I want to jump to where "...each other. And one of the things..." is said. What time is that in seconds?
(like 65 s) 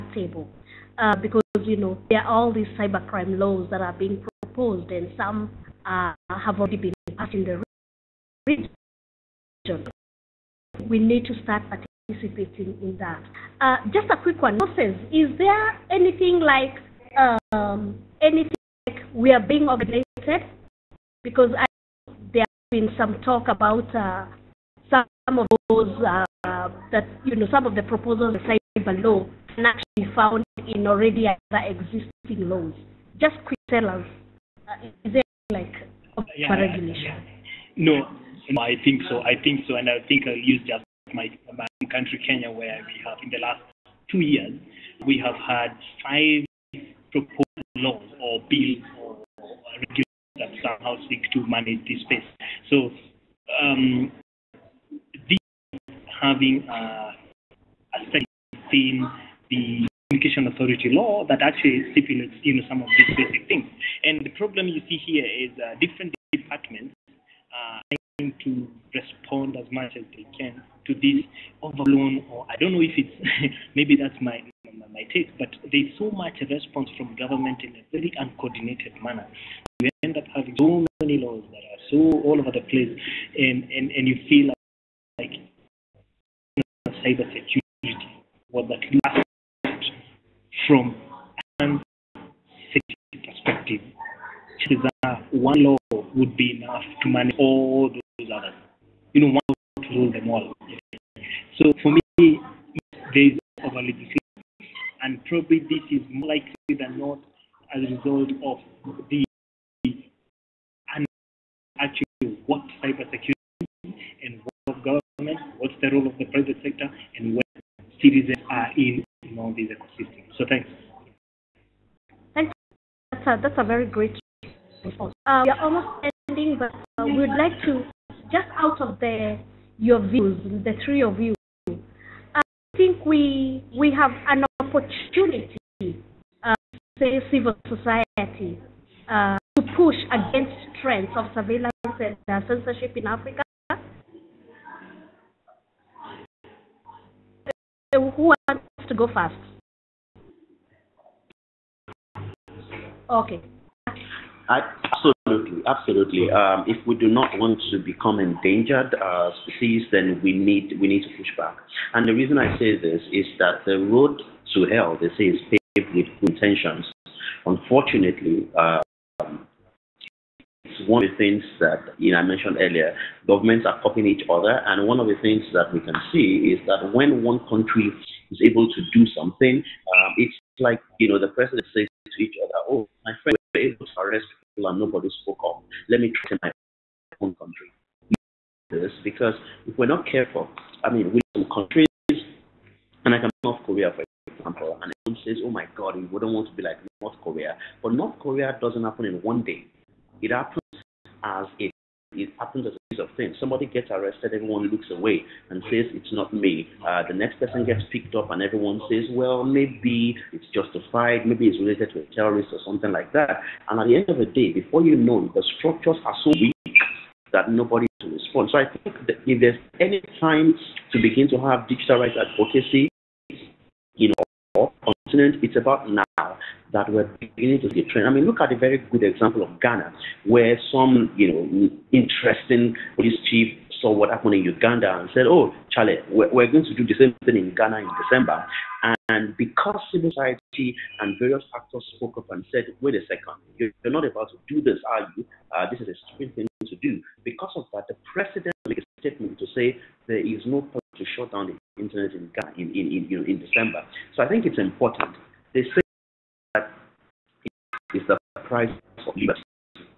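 174 s.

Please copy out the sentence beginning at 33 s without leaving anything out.
Just quick sellers, uh, is there like yeah, regulation?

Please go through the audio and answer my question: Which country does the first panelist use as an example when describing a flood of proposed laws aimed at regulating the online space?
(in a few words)
Kenya.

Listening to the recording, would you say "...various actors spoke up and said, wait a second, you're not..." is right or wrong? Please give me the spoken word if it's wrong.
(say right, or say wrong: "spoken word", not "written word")
right.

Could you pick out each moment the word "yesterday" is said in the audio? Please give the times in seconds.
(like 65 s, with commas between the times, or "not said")
not said.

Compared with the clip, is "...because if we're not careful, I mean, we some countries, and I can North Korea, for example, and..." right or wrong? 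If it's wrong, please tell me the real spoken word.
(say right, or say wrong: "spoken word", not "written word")
right.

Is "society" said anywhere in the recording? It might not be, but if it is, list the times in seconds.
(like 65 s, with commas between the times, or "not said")
137 s, 240 s.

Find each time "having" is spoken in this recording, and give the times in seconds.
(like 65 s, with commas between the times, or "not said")
56 s, 80 s.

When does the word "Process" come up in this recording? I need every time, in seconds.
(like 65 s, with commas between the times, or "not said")
14 s.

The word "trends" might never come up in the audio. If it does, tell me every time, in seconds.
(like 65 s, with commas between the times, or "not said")
140 s, 227 s.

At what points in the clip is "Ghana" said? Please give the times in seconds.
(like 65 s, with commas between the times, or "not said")
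229 s, 237 s.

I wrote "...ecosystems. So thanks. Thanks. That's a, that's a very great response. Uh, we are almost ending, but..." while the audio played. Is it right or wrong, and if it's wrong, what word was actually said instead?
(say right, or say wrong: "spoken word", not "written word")
right.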